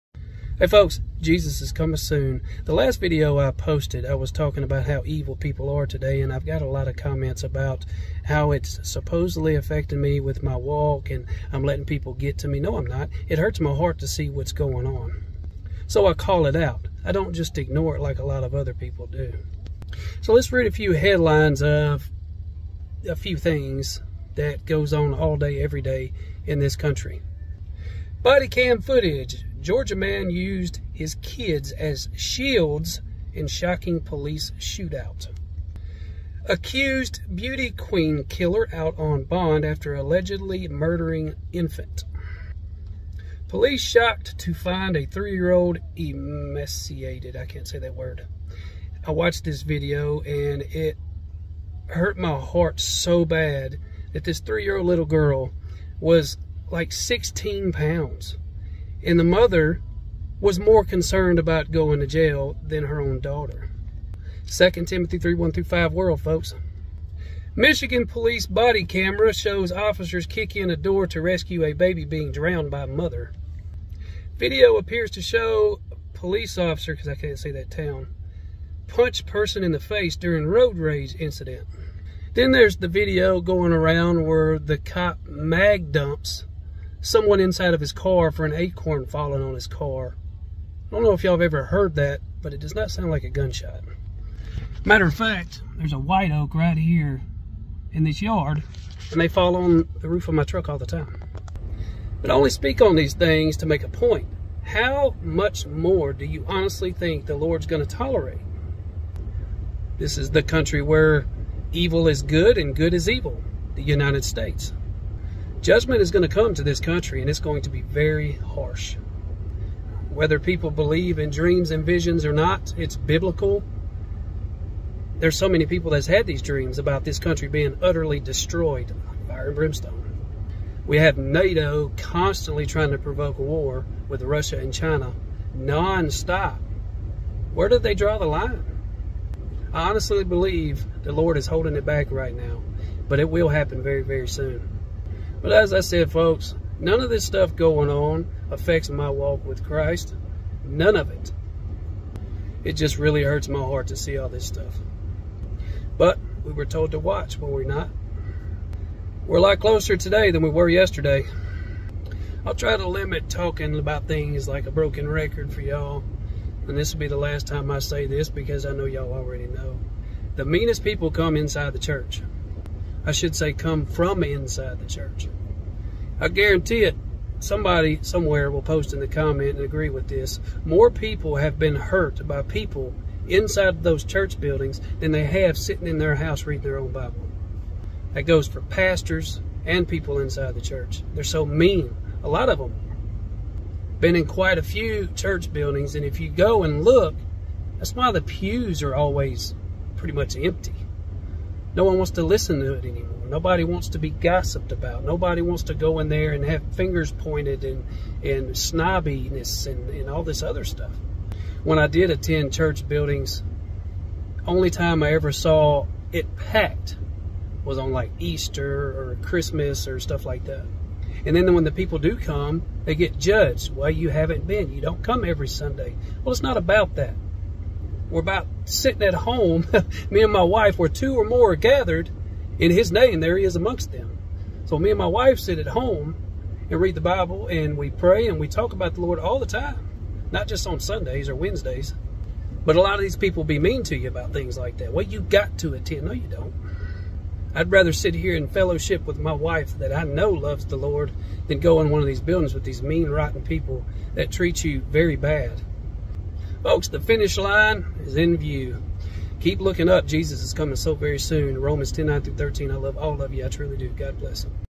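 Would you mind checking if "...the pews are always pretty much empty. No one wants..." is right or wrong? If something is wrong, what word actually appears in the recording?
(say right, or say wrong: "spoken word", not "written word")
right.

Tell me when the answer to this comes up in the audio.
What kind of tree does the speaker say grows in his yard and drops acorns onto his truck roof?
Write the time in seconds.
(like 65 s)
95 s.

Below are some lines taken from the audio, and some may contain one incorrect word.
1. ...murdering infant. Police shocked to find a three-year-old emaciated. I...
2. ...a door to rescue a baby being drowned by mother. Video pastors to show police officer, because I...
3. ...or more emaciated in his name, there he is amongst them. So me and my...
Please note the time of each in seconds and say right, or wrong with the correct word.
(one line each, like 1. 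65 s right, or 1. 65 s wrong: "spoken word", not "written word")
1. 40 s right
2. 70 s wrong: "appears", not "pastors"
3. 231 s wrong: "gathered", not "emaciated".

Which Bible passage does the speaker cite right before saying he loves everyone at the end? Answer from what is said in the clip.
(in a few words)
Romans 10:9-13.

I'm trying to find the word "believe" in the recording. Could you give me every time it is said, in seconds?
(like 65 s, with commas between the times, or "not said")
120 s, 140 s.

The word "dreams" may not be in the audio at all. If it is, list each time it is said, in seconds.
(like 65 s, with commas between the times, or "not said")
121 s, 126 s.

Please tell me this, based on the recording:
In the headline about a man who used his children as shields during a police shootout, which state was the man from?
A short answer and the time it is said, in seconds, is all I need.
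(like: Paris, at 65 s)
Georgia, at 29 s.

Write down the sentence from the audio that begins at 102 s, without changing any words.
But I only speak on these things to make a point.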